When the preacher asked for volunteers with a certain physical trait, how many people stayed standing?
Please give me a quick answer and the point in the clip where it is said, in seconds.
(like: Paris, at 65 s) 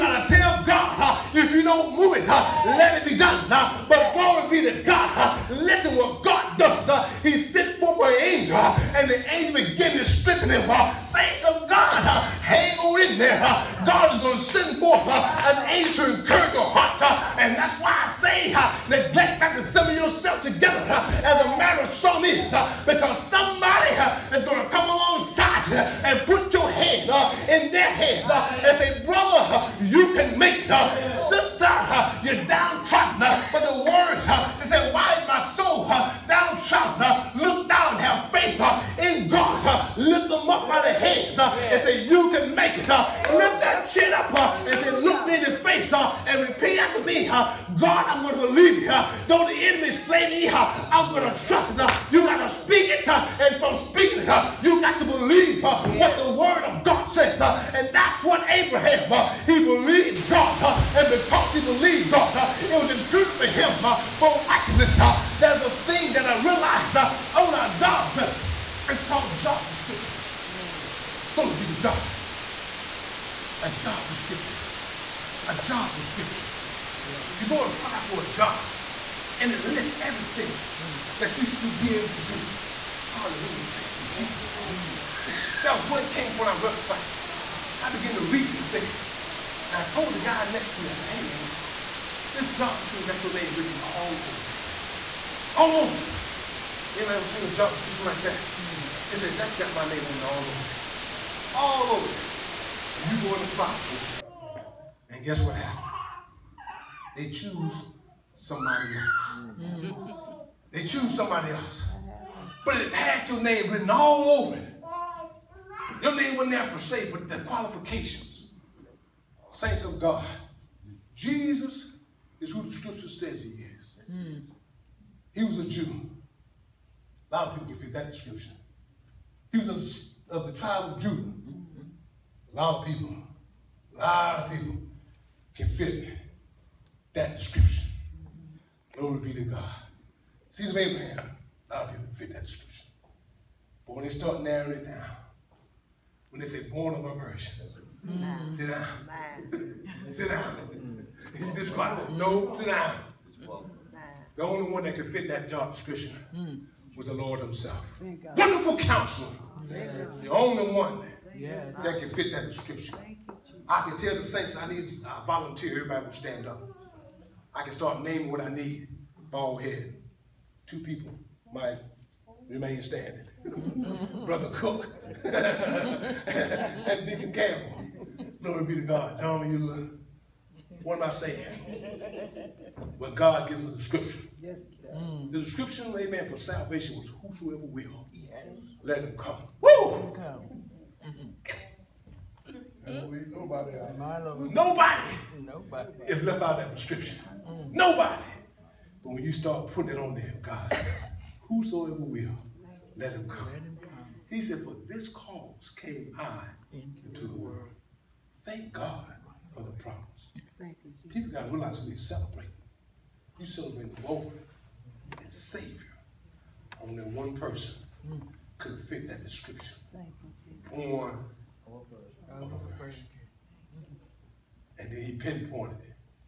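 2, at 170 s.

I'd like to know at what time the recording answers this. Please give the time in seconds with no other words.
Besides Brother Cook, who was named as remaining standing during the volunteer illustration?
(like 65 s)
177 s.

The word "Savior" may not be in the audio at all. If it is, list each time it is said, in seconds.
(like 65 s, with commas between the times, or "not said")
215 s.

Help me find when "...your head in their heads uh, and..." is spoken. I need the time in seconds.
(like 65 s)
26 s.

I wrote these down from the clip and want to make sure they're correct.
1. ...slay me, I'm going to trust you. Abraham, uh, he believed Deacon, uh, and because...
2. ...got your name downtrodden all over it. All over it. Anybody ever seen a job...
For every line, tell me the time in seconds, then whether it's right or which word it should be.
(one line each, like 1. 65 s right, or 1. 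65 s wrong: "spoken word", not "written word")
1. 49 s wrong: "God", not "Deacon"
2. 93 s wrong: "written", not "downtrodden".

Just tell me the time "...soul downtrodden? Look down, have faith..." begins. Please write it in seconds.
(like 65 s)
35 s.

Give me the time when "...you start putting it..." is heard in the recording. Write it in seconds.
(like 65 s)
199 s.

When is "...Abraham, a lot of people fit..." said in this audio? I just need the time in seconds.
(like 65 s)
140 s.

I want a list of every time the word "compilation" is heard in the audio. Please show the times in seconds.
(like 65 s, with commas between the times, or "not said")
not said.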